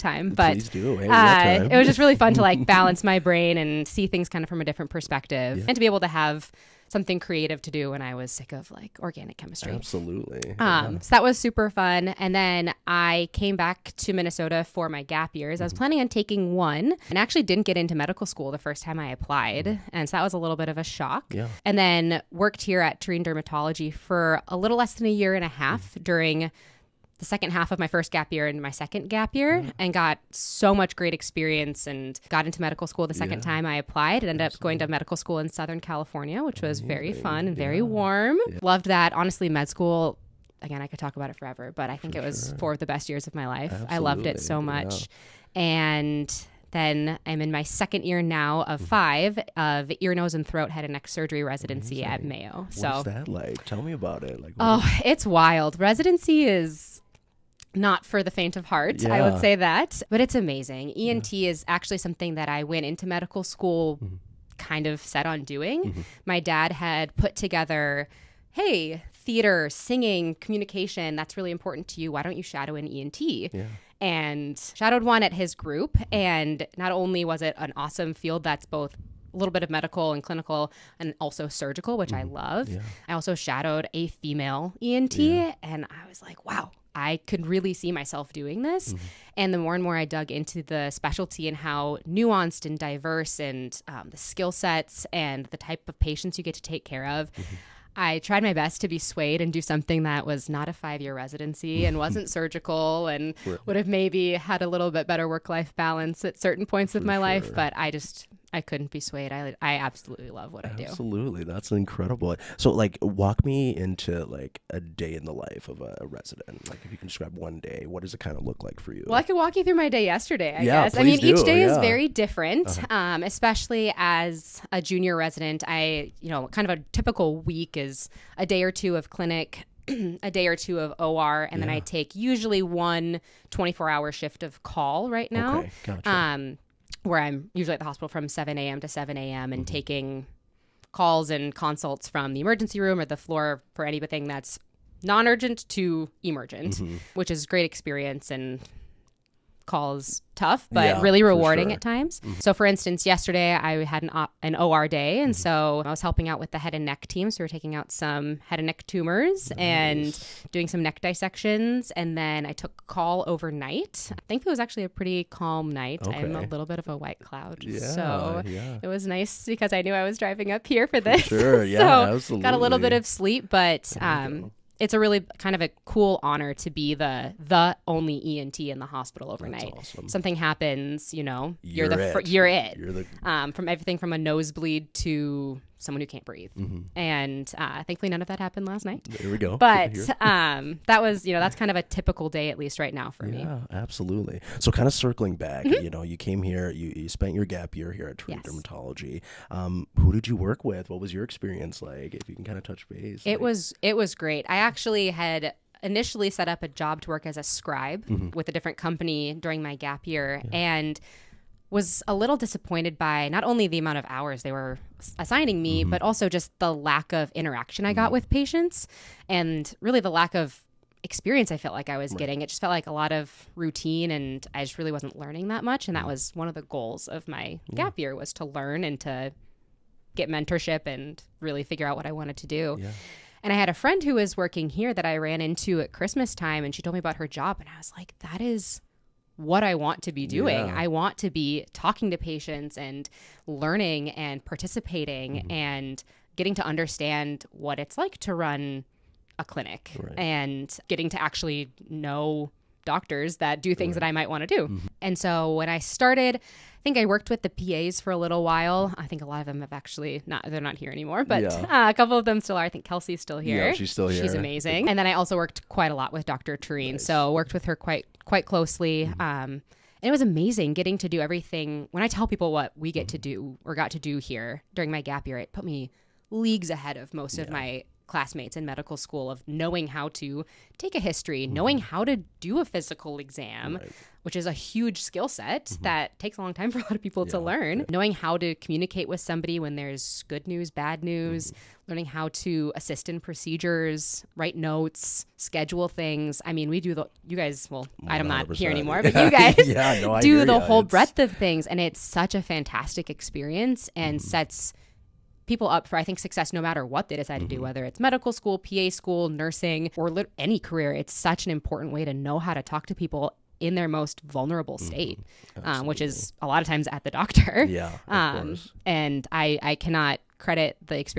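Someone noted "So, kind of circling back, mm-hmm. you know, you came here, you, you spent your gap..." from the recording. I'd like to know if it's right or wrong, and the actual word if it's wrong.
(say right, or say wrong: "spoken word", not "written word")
right.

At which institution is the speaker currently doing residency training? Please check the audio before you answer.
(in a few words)
Mayo.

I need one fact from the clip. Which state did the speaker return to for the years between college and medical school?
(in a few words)
Minnesota.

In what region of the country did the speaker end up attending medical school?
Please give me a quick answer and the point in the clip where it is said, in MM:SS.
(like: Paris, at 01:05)
Southern California, at 00:35.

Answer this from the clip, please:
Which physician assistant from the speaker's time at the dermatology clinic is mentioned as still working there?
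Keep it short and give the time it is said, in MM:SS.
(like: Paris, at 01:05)
Kelsey, at 04:22.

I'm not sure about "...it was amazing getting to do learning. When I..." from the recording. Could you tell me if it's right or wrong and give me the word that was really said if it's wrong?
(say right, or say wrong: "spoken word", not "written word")
wrong: "everything", not "learning".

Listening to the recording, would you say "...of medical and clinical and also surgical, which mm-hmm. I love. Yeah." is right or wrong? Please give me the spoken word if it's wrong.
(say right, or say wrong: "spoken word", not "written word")
right.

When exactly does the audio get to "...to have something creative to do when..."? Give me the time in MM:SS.
00:06.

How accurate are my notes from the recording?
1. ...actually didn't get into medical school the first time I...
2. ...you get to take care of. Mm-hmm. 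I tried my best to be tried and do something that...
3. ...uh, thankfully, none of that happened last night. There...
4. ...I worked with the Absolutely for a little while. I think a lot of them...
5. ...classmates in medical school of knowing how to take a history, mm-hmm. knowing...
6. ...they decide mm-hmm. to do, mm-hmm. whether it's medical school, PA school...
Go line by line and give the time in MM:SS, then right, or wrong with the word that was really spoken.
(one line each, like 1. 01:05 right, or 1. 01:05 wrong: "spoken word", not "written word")
1. 00:17 right
2. 01:36 wrong: "swayed", not "tried"
3. 03:07 right
4. 04:16 wrong: "PAs", not "Absolutely"
5. 04:38 right
6. 05:07 right.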